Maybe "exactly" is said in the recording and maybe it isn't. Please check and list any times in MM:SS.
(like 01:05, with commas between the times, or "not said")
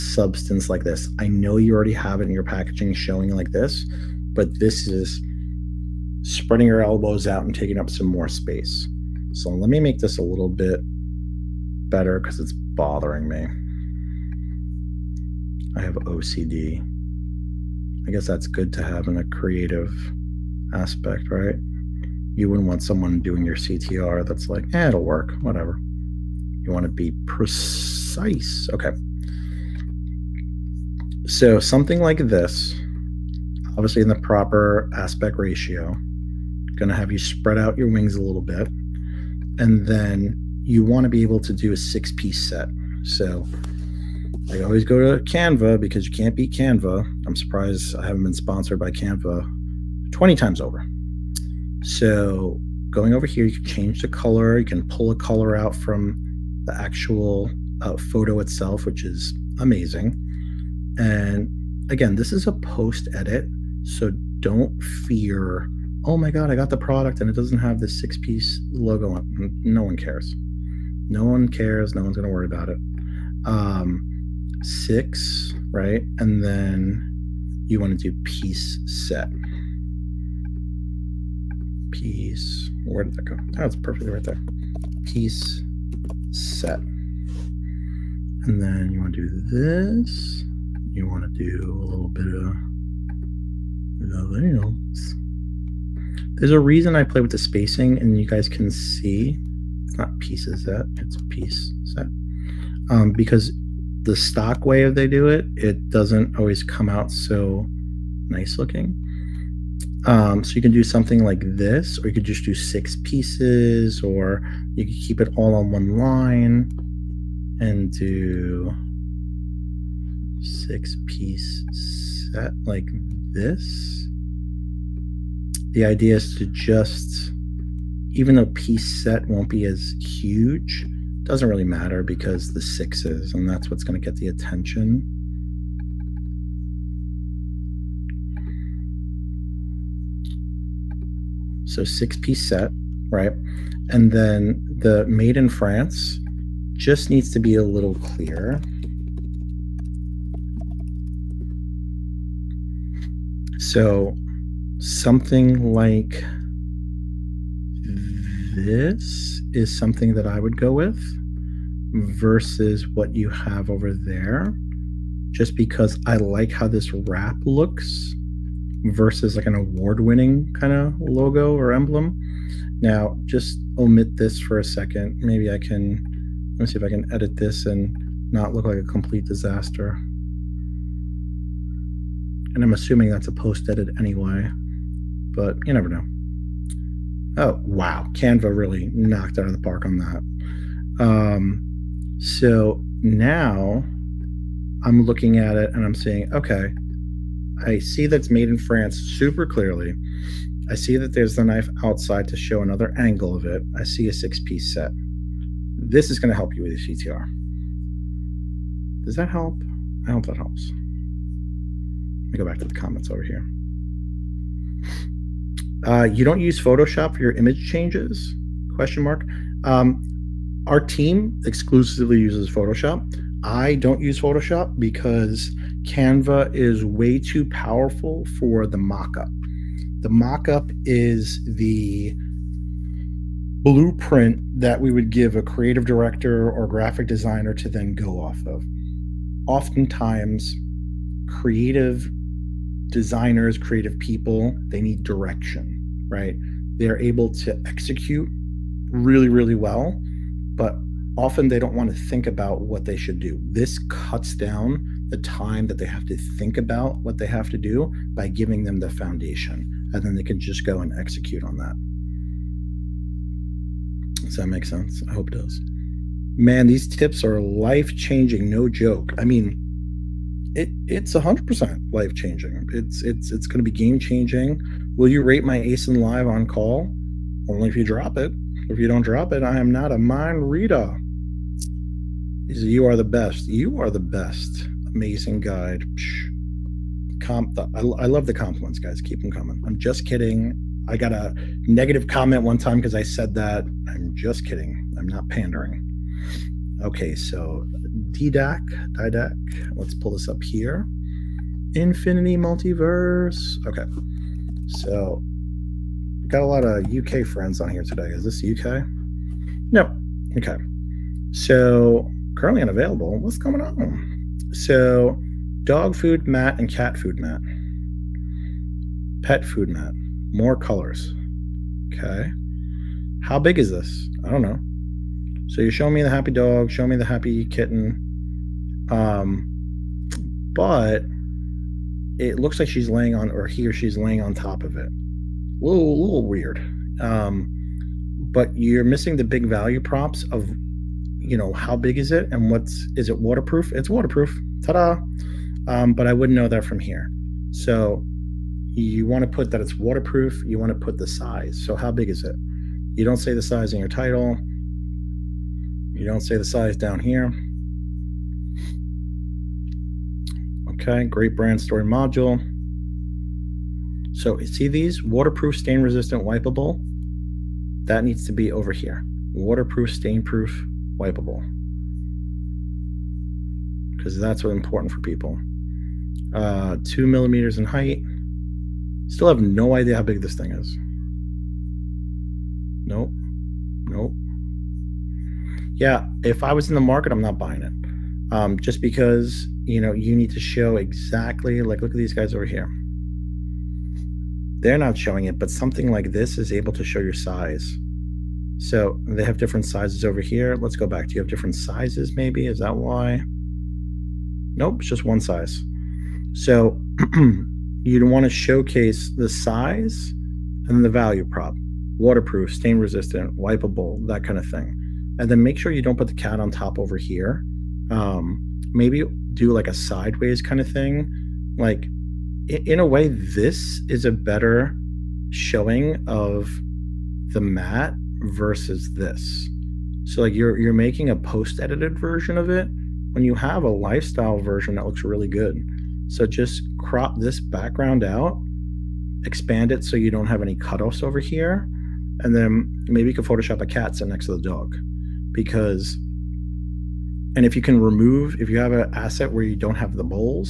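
06:30.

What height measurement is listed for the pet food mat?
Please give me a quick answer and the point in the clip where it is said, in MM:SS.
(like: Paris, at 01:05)
2 millimeters, at 06:16.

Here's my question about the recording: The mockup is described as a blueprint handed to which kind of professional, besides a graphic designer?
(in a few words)
creative director.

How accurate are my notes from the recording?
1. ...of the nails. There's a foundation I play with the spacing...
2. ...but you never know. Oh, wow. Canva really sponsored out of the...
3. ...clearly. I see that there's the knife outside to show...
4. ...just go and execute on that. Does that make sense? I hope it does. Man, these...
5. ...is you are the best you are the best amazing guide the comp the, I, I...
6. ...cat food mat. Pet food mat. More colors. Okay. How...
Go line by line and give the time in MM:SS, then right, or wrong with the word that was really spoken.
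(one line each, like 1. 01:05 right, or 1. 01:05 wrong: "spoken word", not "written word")
1. 01:32 wrong: "reason", not "foundation"
2. 03:05 wrong: "knocked", not "sponsored"
3. 03:19 right
4. 04:20 right
5. 04:42 right
6. 05:16 right.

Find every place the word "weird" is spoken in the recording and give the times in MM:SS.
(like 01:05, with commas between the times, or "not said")
05:36.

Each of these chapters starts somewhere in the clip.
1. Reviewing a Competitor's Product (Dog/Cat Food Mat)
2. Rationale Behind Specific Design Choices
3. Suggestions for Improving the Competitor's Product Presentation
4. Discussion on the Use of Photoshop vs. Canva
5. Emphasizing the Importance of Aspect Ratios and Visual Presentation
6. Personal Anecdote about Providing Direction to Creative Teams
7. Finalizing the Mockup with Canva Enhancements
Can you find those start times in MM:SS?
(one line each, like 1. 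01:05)
1. 05:11
2. 02:03
3. 07:00
4. 03:32
5. 00:29
6. 04:28
7. 03:08.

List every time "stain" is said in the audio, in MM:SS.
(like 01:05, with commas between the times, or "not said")
06:05, 06:09, 06:52.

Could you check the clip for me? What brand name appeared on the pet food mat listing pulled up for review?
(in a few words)
Infinity Multiverse.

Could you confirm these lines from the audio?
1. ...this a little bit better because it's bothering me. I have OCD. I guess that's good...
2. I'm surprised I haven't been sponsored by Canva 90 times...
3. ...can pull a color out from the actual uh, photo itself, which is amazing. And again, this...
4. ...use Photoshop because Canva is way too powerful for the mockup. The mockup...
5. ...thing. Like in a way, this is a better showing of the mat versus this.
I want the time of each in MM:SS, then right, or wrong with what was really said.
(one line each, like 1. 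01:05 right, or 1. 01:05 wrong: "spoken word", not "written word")
1. 00:09 right
2. 00:47 wrong: "20", not "90"
3. 00:54 right
4. 03:44 right
5. 07:00 right.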